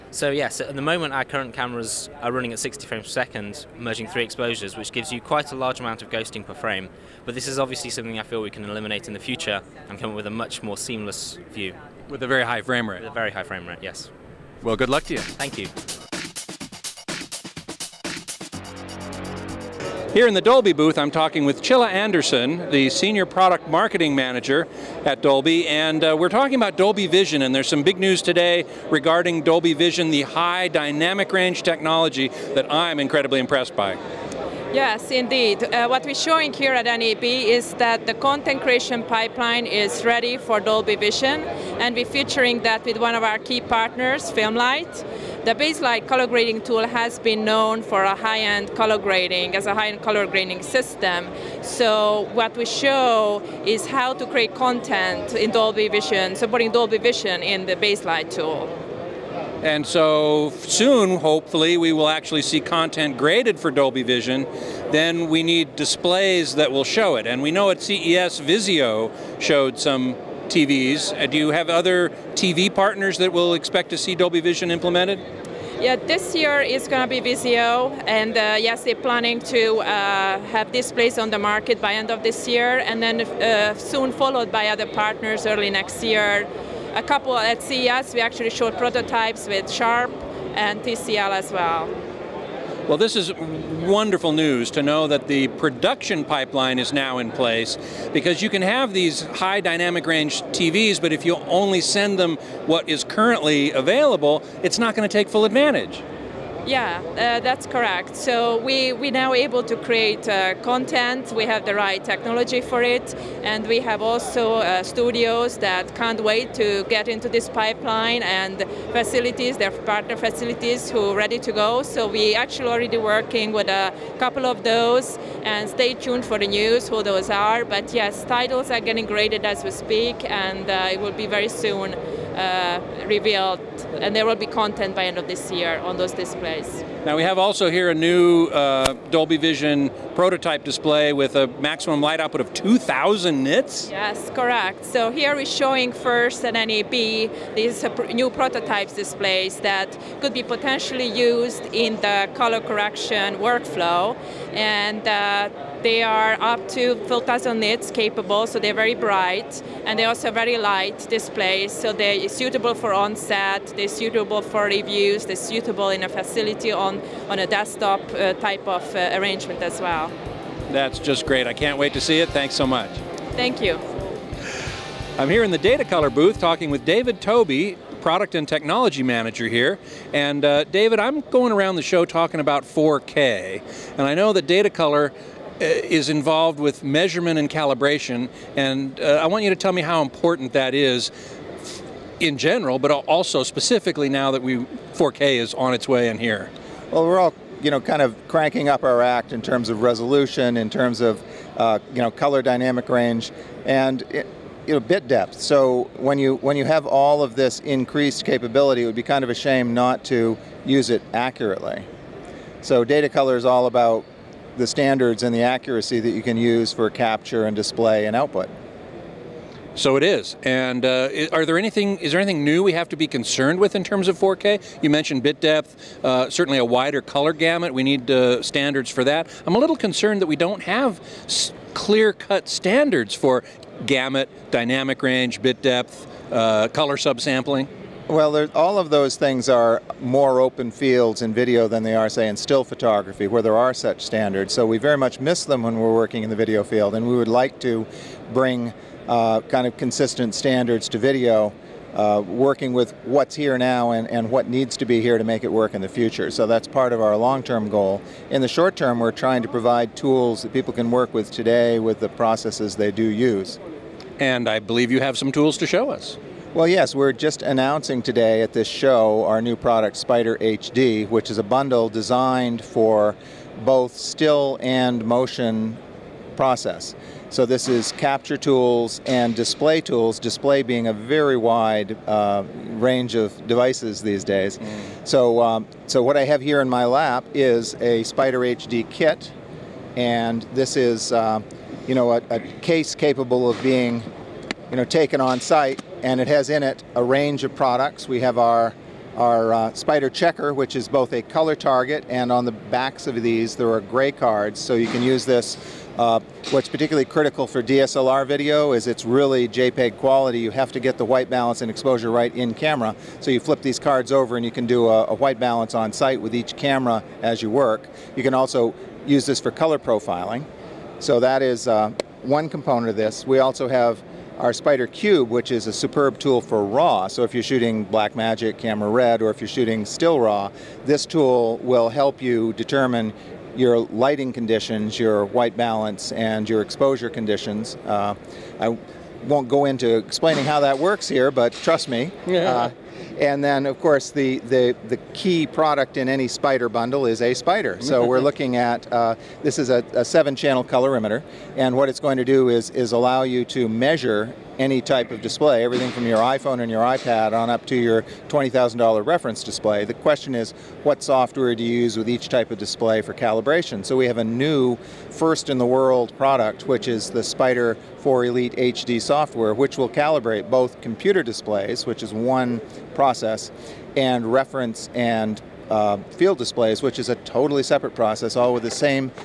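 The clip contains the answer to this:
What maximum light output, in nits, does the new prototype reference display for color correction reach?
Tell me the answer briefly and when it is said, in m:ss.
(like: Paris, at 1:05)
2,000, at 2:22.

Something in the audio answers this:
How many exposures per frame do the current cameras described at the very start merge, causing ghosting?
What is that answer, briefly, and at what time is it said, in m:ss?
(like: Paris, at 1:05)
3, at 0:04.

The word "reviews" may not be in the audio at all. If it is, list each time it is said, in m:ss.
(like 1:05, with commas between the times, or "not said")
2:44.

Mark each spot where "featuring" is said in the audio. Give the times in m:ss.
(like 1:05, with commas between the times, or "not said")
0:42.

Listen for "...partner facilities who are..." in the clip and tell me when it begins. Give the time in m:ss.
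1:59.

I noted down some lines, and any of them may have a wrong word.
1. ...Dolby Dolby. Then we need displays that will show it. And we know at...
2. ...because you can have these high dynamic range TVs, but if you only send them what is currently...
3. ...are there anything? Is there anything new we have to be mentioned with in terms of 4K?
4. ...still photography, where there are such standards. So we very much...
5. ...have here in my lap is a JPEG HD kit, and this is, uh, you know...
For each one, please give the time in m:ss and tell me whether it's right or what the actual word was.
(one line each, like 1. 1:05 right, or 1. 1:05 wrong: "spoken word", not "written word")
1. 1:03 wrong: "Vision", not "Dolby"
2. 1:38 right
3. 3:41 wrong: "concerned", not "mentioned"
4. 4:02 right
5. 4:46 wrong: "Spyder", not "JPEG".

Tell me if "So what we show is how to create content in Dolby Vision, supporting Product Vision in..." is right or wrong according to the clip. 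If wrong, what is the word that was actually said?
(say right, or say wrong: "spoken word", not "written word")
wrong: "Dolby", not "Product".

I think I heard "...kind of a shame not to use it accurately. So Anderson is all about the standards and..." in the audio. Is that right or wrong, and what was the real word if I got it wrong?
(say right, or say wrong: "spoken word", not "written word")
wrong: "Datacolor", not "Anderson".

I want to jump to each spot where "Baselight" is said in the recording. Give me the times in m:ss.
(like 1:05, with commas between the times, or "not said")
0:45, 0:57.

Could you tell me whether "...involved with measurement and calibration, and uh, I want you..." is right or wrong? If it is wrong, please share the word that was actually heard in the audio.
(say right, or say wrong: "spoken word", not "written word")
right.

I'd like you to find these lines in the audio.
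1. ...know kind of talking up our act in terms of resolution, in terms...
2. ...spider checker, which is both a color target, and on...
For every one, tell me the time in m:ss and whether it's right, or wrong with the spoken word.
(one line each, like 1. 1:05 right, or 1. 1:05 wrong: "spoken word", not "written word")
1. 3:17 wrong: "cranking", not "talking"
2. 4:59 right.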